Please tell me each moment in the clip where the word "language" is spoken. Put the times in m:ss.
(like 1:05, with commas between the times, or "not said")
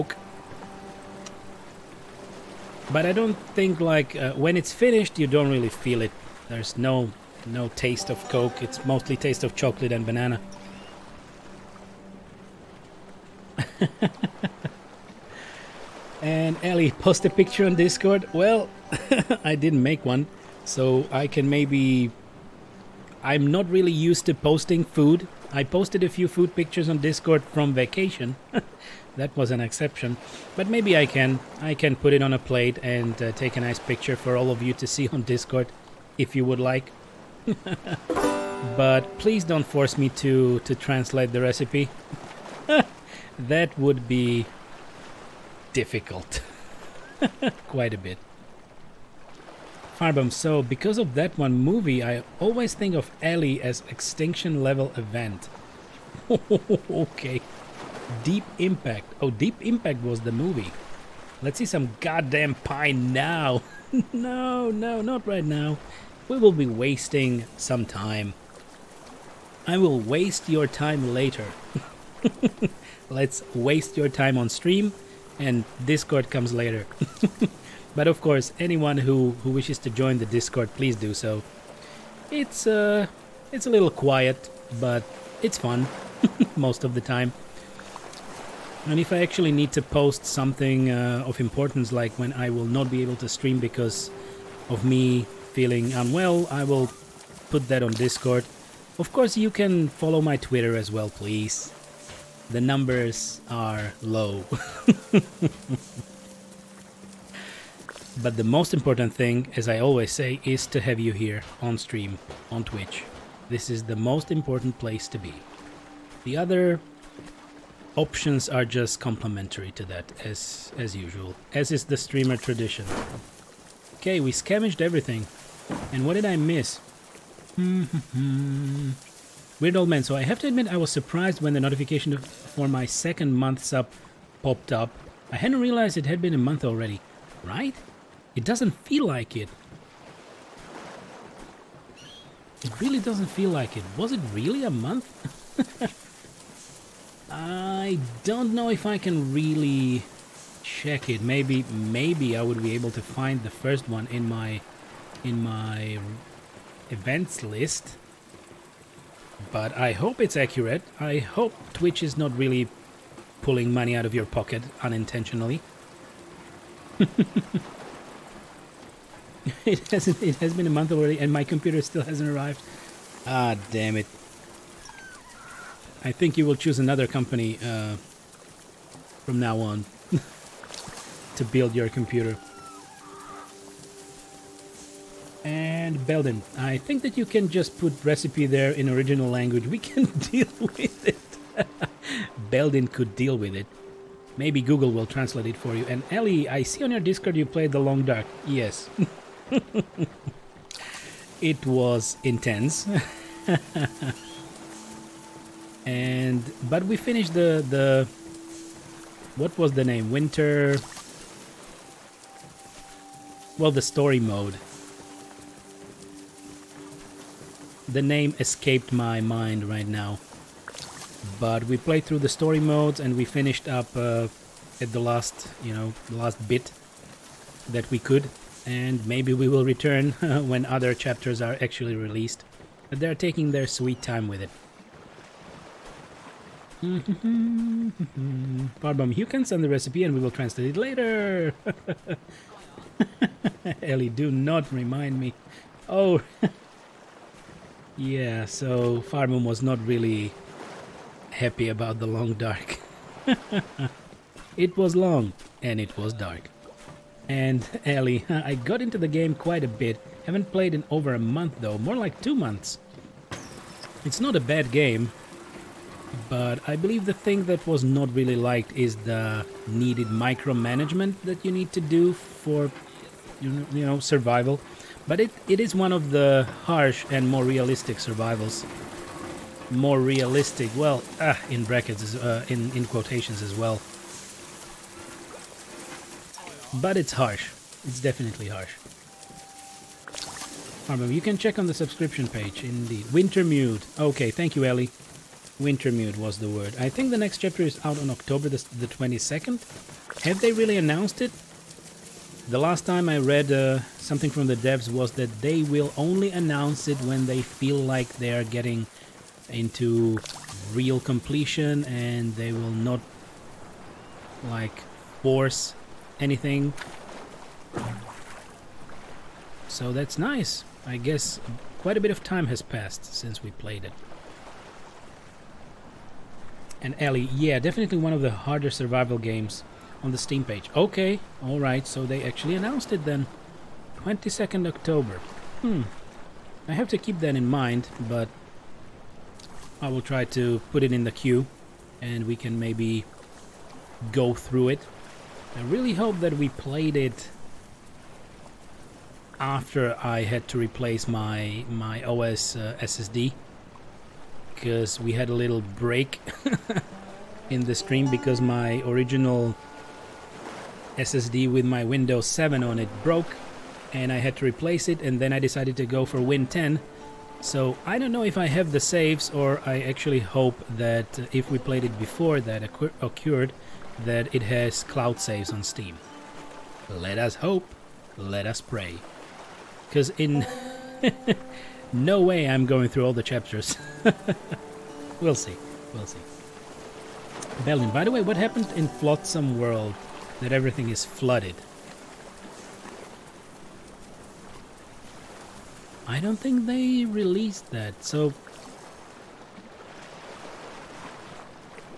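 3:09.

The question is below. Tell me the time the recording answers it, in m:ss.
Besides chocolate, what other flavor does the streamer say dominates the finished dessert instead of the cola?
0:10.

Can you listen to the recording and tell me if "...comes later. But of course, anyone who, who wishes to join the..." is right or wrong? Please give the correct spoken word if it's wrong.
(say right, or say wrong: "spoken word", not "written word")
right.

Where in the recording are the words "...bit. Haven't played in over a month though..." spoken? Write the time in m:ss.
4:19.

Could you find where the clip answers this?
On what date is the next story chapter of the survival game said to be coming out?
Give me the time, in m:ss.
4:58.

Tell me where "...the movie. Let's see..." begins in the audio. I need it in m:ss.
1:00.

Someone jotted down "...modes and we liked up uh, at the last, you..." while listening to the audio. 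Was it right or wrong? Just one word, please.
wrong.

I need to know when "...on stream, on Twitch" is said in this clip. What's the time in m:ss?
1:51.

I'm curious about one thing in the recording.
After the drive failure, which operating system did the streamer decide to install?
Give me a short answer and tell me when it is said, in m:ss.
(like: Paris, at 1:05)
Windows 10, at 6:06.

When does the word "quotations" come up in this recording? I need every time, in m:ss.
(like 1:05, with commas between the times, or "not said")
4:42.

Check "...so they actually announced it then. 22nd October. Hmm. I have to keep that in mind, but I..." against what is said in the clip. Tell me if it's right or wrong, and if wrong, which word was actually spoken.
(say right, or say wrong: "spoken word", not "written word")
right.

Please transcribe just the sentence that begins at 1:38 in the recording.
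Of course, you can follow my Twitter as well, please.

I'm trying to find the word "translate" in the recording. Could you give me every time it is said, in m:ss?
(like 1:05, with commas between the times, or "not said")
0:40, 3:15, 4:00.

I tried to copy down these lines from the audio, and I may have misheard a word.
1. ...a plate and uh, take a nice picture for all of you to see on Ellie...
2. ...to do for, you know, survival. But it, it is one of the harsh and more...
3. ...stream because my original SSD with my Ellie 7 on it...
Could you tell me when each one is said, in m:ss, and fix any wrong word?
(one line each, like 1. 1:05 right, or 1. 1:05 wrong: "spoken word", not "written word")
1. 0:32 wrong: "Discord", not "Ellie"
2. 4:31 right
3. 5:57 wrong: "Windows", not "Ellie".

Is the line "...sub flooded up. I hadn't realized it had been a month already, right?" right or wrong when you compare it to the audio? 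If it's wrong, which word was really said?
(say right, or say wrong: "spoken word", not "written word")
wrong: "popped", not "flooded".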